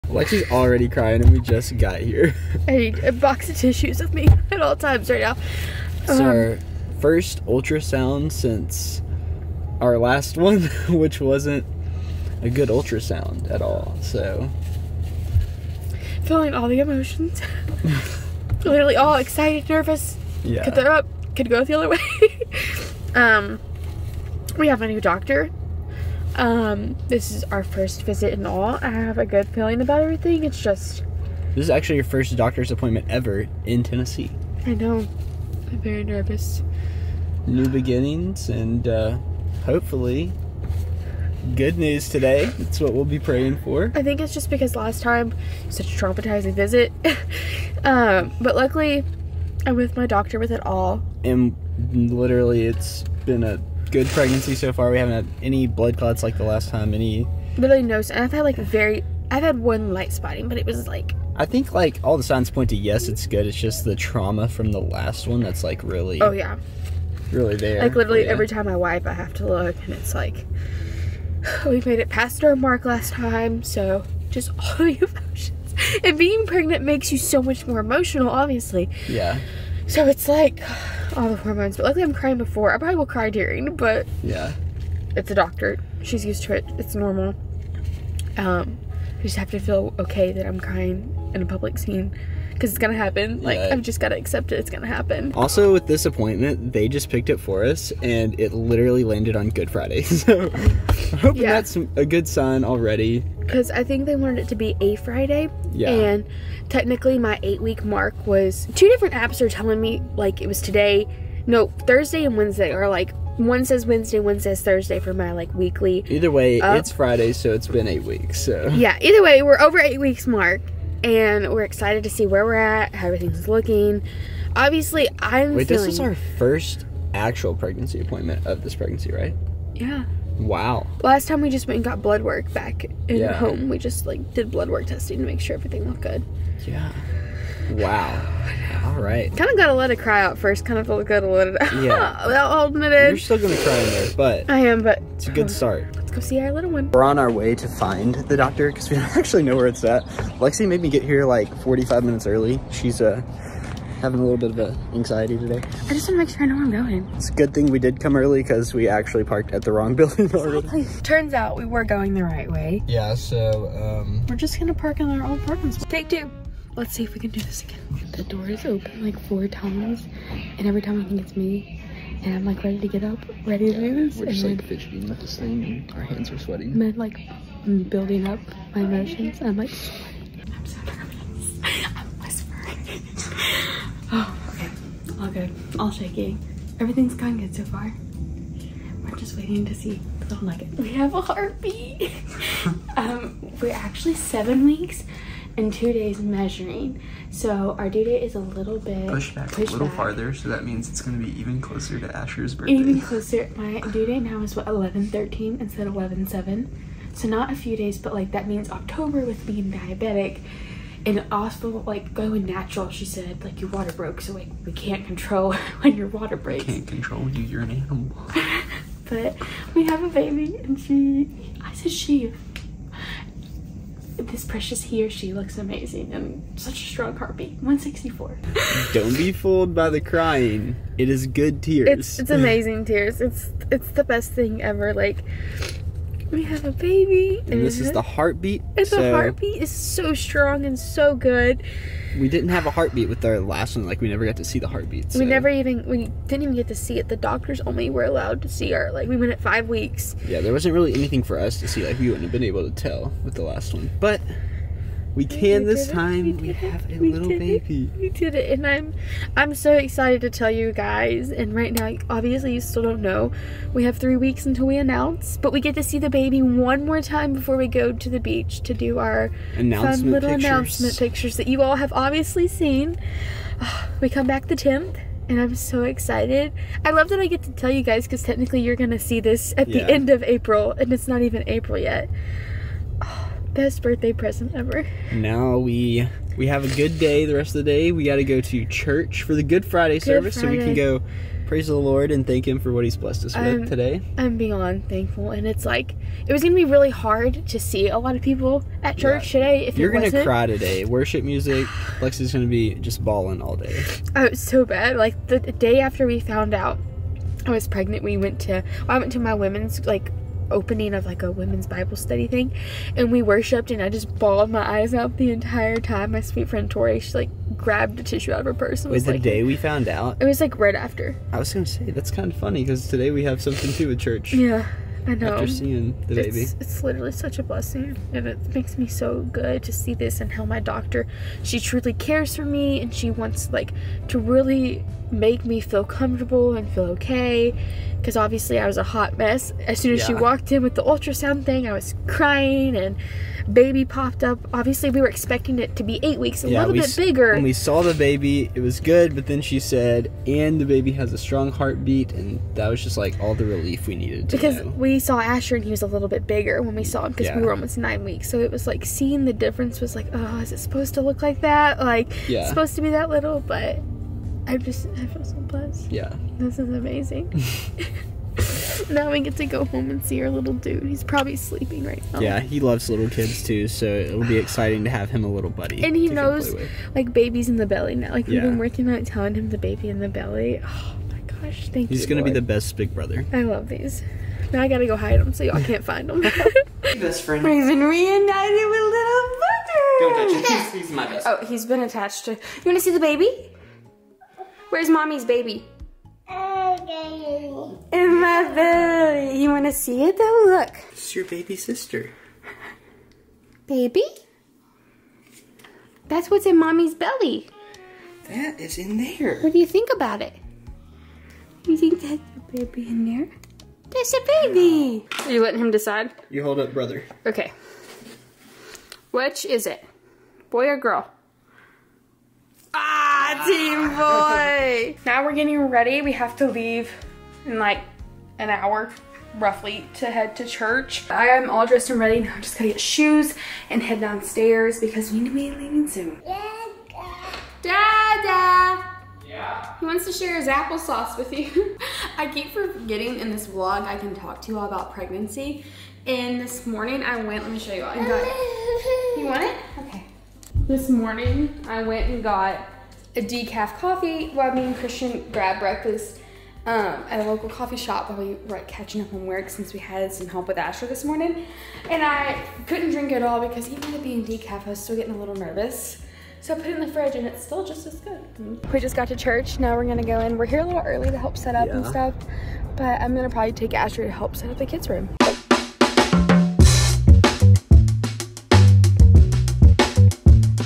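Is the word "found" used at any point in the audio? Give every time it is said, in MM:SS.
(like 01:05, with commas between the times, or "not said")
05:06, 05:19.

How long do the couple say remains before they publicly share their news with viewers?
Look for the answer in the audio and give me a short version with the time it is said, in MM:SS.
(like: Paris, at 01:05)
3 weeks, at 04:23.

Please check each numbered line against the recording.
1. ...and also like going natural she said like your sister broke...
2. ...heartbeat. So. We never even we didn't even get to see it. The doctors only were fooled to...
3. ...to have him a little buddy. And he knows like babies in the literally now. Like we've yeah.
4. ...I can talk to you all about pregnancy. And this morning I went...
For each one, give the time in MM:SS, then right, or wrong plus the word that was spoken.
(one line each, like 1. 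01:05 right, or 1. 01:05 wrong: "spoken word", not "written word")
1. 03:31 wrong: "water", not "sister"
2. 04:04 wrong: "allowed", not "fooled"
3. 06:14 wrong: "belly", not "literally"
4. 07:23 right.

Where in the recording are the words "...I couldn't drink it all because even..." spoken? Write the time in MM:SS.
07:42.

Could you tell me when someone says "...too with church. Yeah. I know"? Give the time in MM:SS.
05:23.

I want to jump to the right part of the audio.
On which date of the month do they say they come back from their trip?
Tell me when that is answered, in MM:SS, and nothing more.
04:34.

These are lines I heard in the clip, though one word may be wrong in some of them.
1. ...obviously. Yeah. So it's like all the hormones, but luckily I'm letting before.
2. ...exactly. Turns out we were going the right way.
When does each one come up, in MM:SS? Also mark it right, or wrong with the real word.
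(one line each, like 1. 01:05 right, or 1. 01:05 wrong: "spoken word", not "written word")
1. 01:18 wrong: "crying", not "letting"
2. 02:40 right.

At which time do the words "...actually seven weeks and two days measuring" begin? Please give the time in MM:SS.
03:13.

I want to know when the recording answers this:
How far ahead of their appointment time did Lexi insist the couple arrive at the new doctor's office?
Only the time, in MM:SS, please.
02:31.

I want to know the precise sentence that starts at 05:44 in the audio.
Obviously, we were expecting it to be eight weeks, a yeah, little bit bigger.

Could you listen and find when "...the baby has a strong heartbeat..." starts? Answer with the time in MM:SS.
05:50.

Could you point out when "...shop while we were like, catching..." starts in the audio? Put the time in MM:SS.
07:37.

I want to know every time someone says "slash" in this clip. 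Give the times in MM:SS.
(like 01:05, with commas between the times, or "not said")
not said.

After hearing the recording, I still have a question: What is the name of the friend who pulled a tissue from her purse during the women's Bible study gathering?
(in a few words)
Tori.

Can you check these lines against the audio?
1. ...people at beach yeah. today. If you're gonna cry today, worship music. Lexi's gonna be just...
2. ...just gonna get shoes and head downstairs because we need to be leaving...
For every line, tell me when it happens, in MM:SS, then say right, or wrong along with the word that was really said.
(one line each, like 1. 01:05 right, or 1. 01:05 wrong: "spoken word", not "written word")
1. 04:58 wrong: "church", not "beach"
2. 07:12 right.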